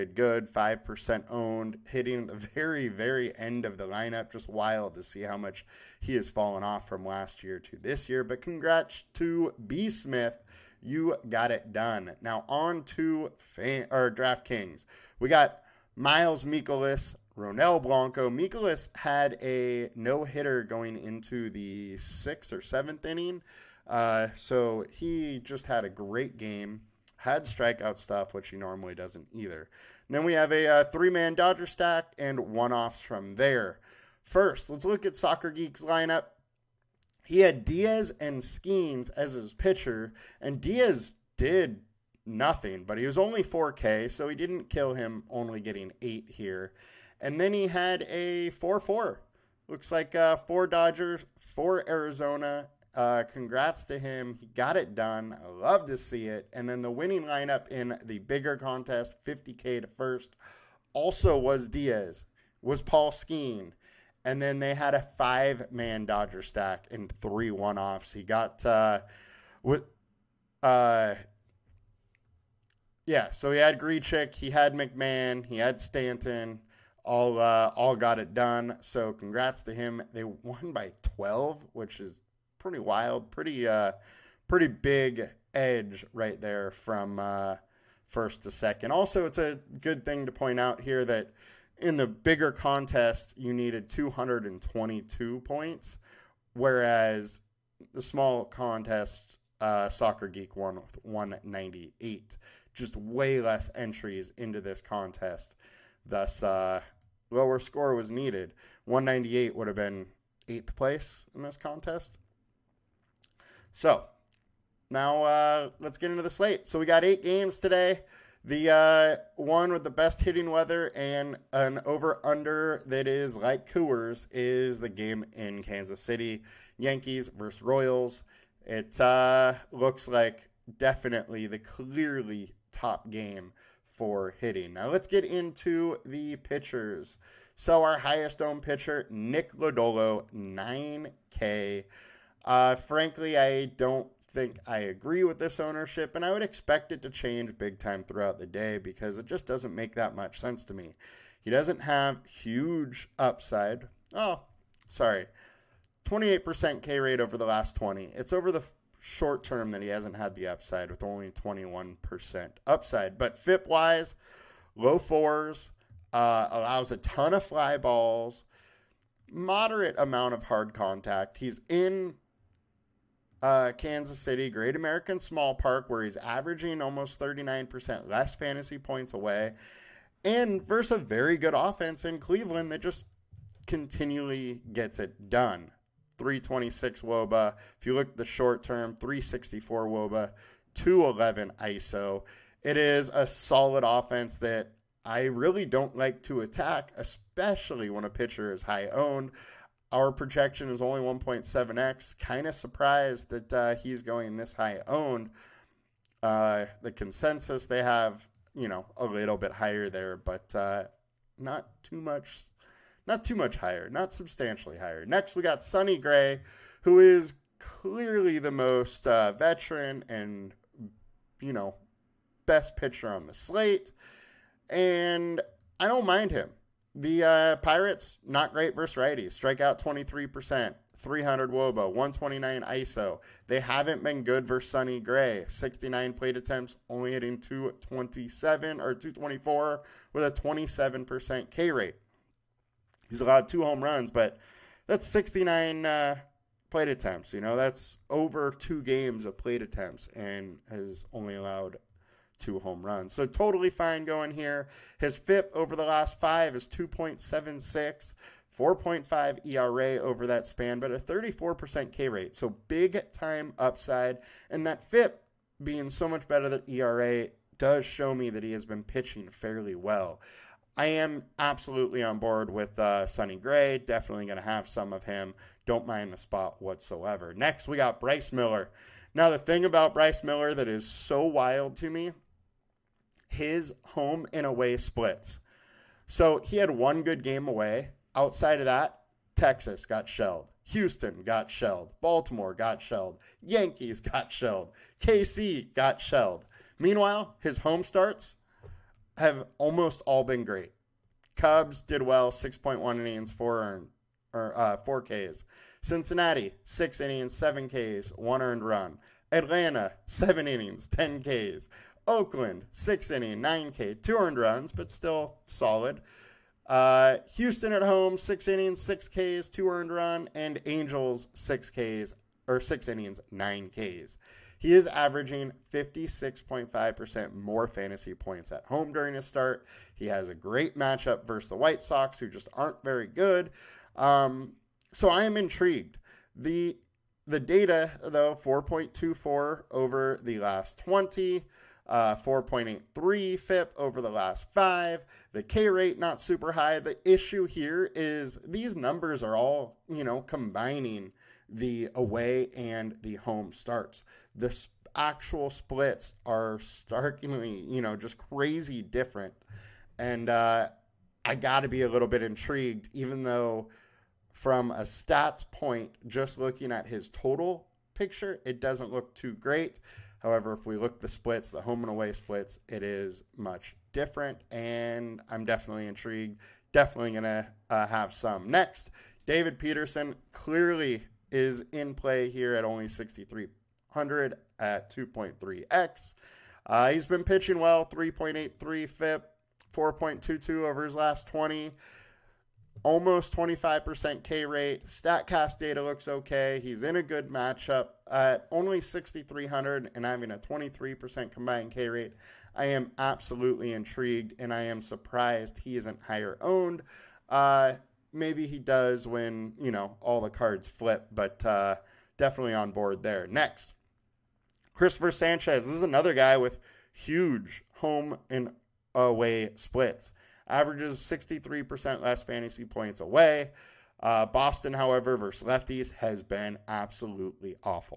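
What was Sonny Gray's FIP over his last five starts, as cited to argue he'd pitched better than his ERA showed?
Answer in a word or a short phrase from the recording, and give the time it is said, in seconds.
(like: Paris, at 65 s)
2.76, at 256 s.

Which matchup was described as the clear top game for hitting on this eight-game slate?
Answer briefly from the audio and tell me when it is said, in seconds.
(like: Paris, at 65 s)
Yankees versus Royals, at 126 s.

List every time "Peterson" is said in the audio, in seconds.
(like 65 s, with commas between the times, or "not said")
379 s.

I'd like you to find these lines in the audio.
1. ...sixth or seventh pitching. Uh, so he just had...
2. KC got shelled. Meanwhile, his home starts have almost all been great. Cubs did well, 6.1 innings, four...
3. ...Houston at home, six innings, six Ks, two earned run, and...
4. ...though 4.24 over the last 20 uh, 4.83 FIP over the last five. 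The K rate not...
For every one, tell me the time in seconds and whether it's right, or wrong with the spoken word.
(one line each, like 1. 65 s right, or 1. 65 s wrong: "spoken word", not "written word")
1. 21 s wrong: "inning", not "pitching"
2. 294 s right
3. 317 s right
4. 338 s right.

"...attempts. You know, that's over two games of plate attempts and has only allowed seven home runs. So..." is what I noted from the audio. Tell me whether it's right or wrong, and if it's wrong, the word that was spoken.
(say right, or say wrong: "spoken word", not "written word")
wrong: "two", not "seven".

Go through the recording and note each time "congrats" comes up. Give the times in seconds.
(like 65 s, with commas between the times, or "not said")
8 s, 53 s, 79 s.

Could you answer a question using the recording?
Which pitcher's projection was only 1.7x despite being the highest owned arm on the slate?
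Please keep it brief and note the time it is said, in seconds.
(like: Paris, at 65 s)
Nick Lodolo, at 139 s.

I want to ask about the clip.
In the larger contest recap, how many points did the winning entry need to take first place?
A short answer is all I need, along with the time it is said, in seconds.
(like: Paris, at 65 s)
222, at 93 s.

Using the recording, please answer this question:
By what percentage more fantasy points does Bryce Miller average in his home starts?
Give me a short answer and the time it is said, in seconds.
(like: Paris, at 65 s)
56.5%, at 325 s.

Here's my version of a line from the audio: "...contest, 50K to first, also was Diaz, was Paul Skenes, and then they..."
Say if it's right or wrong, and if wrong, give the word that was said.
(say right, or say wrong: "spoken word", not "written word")
right.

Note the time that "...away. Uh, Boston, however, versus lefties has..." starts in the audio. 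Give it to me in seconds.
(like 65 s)
422 s.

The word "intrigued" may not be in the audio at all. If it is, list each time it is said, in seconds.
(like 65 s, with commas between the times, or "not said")
335 s, 362 s, 375 s, 403 s.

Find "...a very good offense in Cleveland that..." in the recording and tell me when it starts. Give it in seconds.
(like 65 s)
180 s.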